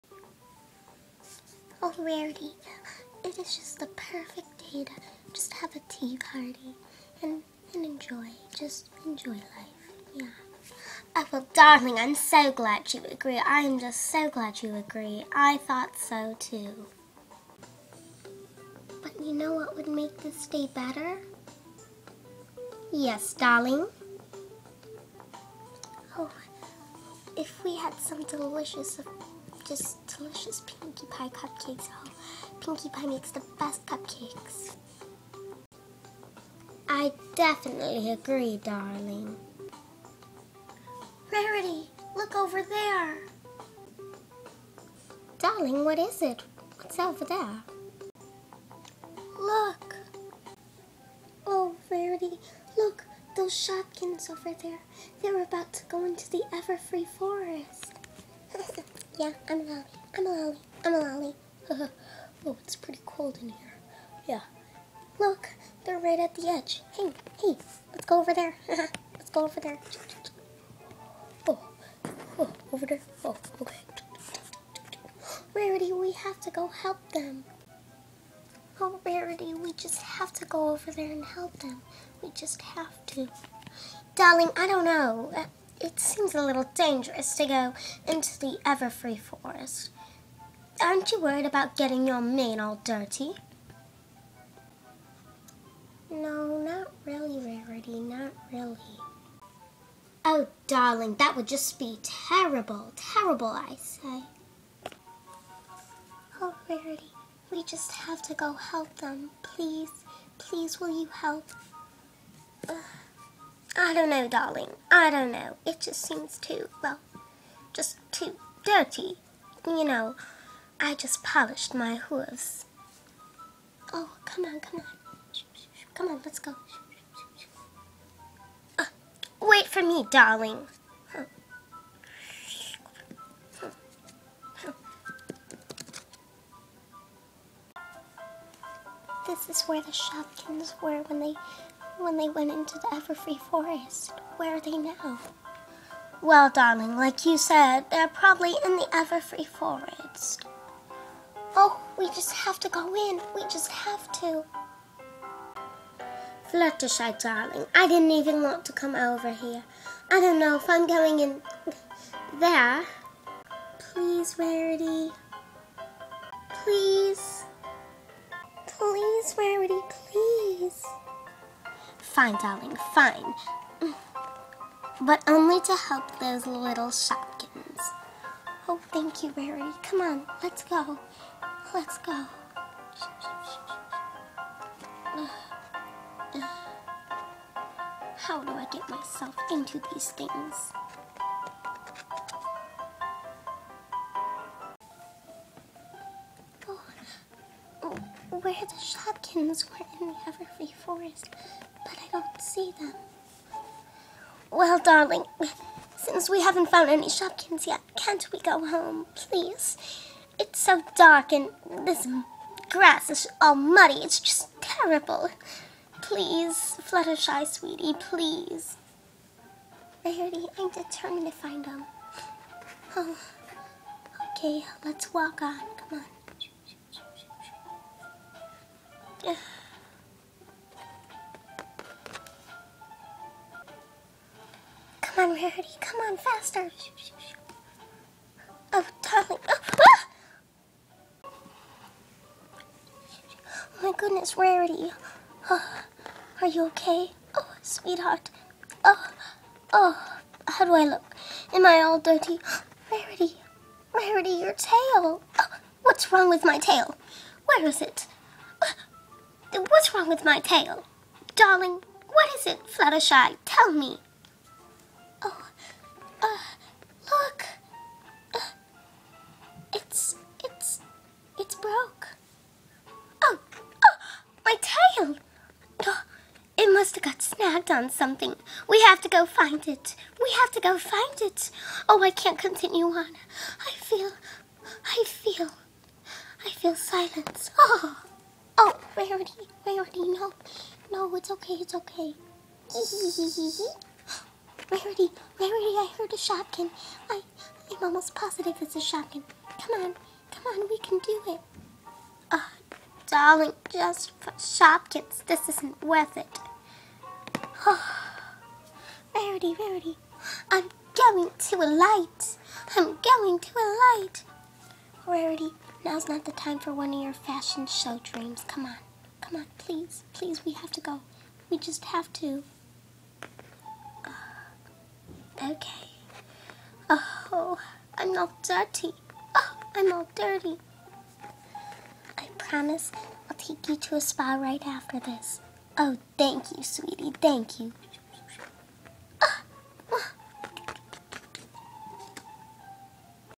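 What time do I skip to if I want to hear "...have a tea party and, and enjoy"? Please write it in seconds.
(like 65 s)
5 s.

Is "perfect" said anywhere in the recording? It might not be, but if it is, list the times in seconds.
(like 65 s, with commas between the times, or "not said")
3 s.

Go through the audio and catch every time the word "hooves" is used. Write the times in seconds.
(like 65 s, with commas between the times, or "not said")
121 s.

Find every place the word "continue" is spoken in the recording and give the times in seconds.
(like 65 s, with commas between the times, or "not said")
282 s.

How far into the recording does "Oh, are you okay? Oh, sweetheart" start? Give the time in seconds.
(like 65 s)
245 s.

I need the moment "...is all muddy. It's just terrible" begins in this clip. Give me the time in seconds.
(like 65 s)
213 s.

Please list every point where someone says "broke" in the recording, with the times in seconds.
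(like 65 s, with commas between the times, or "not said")
271 s.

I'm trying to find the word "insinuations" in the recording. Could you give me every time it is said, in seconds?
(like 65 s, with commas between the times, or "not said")
not said.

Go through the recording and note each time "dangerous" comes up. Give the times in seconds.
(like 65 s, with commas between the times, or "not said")
86 s.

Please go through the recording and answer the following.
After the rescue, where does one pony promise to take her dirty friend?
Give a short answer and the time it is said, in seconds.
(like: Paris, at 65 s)
A spa, at 334 s.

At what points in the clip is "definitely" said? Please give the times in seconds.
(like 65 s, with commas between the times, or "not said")
37 s.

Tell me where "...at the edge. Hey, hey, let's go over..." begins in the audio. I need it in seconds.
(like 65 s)
66 s.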